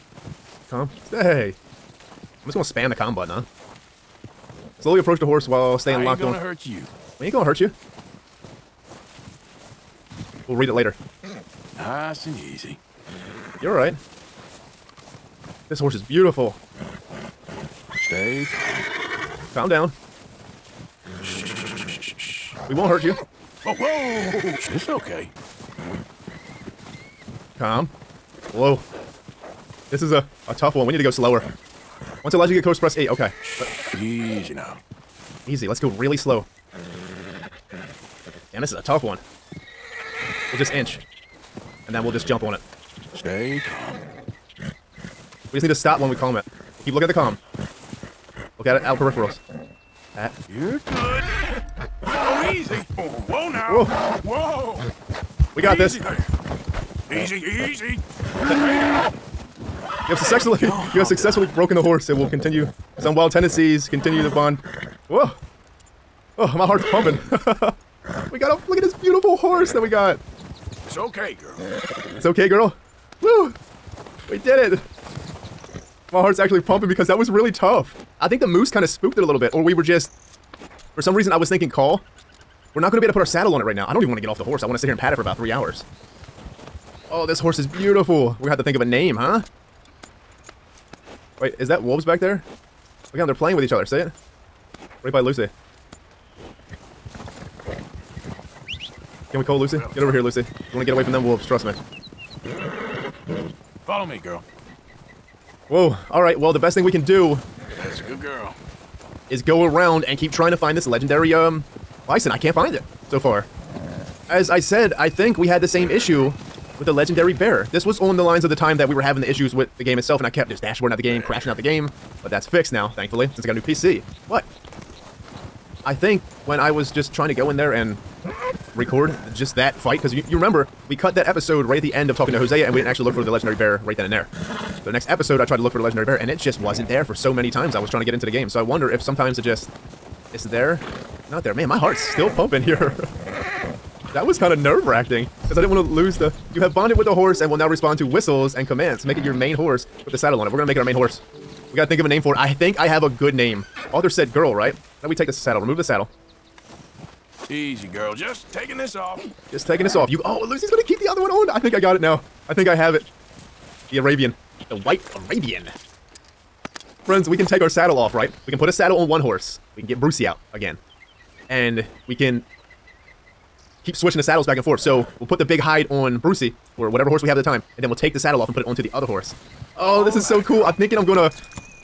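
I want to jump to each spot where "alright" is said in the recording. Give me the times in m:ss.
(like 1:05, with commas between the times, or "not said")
0:13, 1:46.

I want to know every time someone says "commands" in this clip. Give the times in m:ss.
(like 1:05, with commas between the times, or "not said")
2:28.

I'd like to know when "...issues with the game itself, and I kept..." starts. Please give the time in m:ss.
1:59.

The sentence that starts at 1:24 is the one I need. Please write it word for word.
I want to sit here and pat it for about three hours.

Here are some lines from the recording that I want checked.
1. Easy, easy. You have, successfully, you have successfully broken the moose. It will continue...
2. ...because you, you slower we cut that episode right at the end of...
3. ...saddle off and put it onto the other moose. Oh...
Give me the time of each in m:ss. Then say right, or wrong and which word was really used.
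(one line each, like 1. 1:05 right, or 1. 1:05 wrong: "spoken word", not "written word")
1. 0:57 wrong: "horse", not "moose"
2. 2:09 wrong: "remember", not "slower"
3. 2:58 wrong: "horse", not "moose".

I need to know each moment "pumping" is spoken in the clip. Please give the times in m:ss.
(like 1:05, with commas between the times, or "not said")
1:06, 1:16, 2:22.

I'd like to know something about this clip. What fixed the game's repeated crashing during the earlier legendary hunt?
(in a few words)
A new PC.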